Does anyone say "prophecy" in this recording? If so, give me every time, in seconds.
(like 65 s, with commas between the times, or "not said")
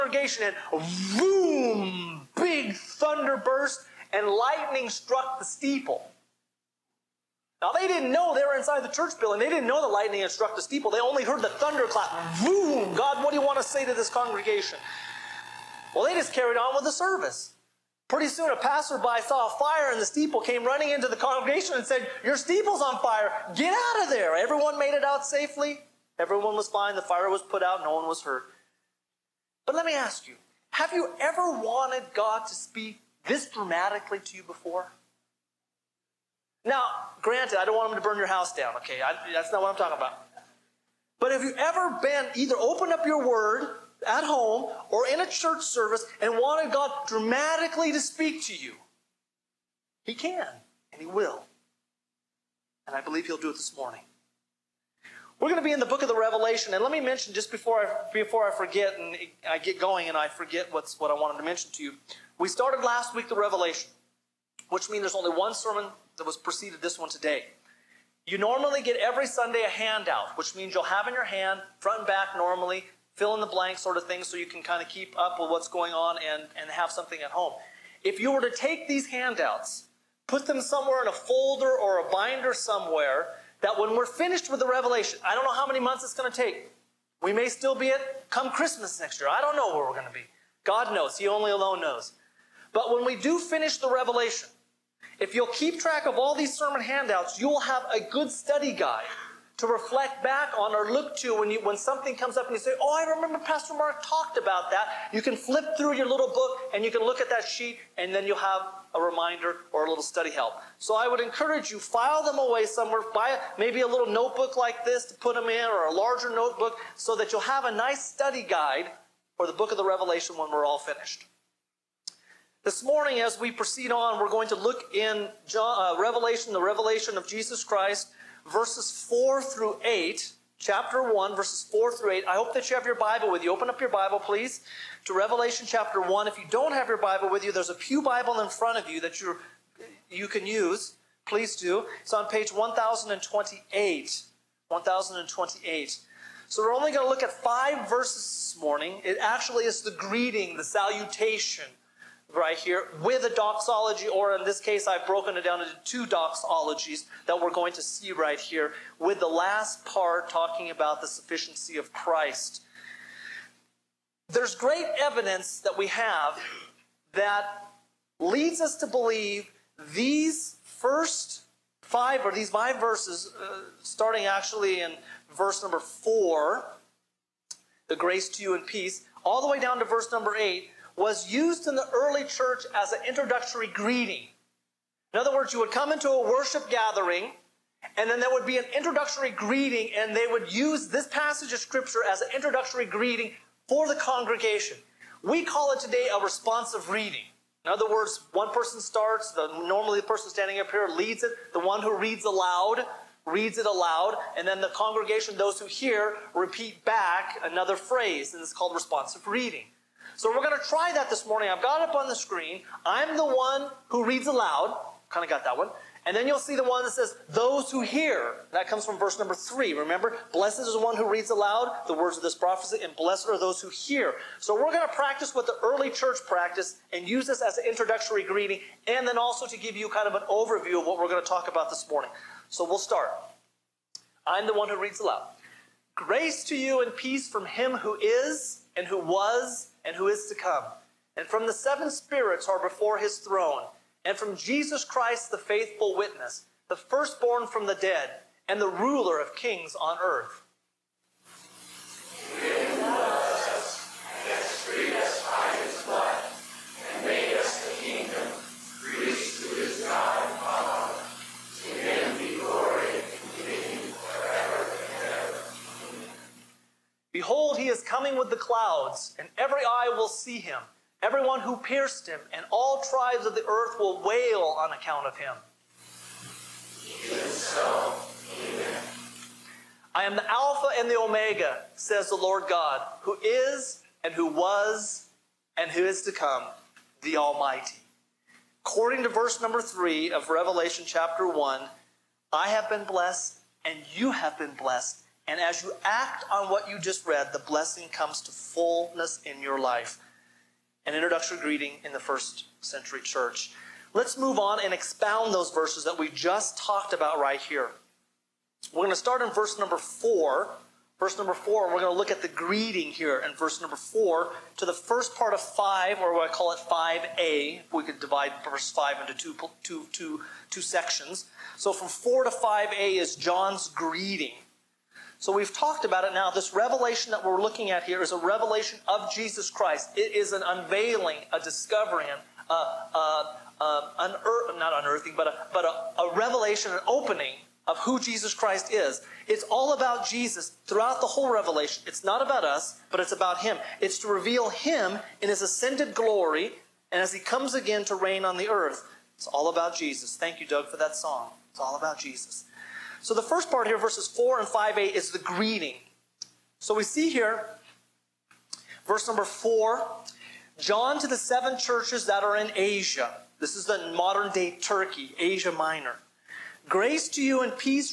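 222 s.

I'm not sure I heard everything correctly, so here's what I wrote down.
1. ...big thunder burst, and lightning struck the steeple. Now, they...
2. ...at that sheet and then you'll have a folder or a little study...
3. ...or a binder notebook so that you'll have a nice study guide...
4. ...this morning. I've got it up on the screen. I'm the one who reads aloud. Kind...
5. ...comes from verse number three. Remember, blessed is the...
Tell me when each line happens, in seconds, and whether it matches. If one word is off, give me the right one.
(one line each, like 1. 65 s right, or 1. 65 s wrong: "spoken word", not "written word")
1. 2 s right
2. 107 s wrong: "reminder", not "folder"
3. 115 s wrong: "larger", not "binder"
4. 211 s right
5. 218 s right.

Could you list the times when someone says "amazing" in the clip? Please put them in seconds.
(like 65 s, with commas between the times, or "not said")
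not said.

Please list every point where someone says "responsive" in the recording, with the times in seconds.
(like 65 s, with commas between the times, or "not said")
196 s, 208 s.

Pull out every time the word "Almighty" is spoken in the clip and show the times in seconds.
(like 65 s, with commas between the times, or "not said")
287 s.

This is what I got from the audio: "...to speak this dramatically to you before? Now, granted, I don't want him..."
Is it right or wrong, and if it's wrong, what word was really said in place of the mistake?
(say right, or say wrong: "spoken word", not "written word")
right.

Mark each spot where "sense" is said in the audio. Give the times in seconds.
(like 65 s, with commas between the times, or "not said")
not said.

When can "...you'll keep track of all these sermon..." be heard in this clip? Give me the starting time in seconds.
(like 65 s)
95 s.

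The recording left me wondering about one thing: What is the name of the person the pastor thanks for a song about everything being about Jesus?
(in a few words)
Doug.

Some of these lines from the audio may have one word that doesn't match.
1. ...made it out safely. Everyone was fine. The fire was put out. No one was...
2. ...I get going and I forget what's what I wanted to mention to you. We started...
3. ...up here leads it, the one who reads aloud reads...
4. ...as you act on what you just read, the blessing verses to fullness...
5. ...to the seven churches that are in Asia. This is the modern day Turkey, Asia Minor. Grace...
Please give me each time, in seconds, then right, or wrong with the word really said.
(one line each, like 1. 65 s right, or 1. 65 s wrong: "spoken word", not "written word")
1. 24 s right
2. 59 s right
3. 200 s right
4. 295 s wrong: "comes", not "verses"
5. 361 s right.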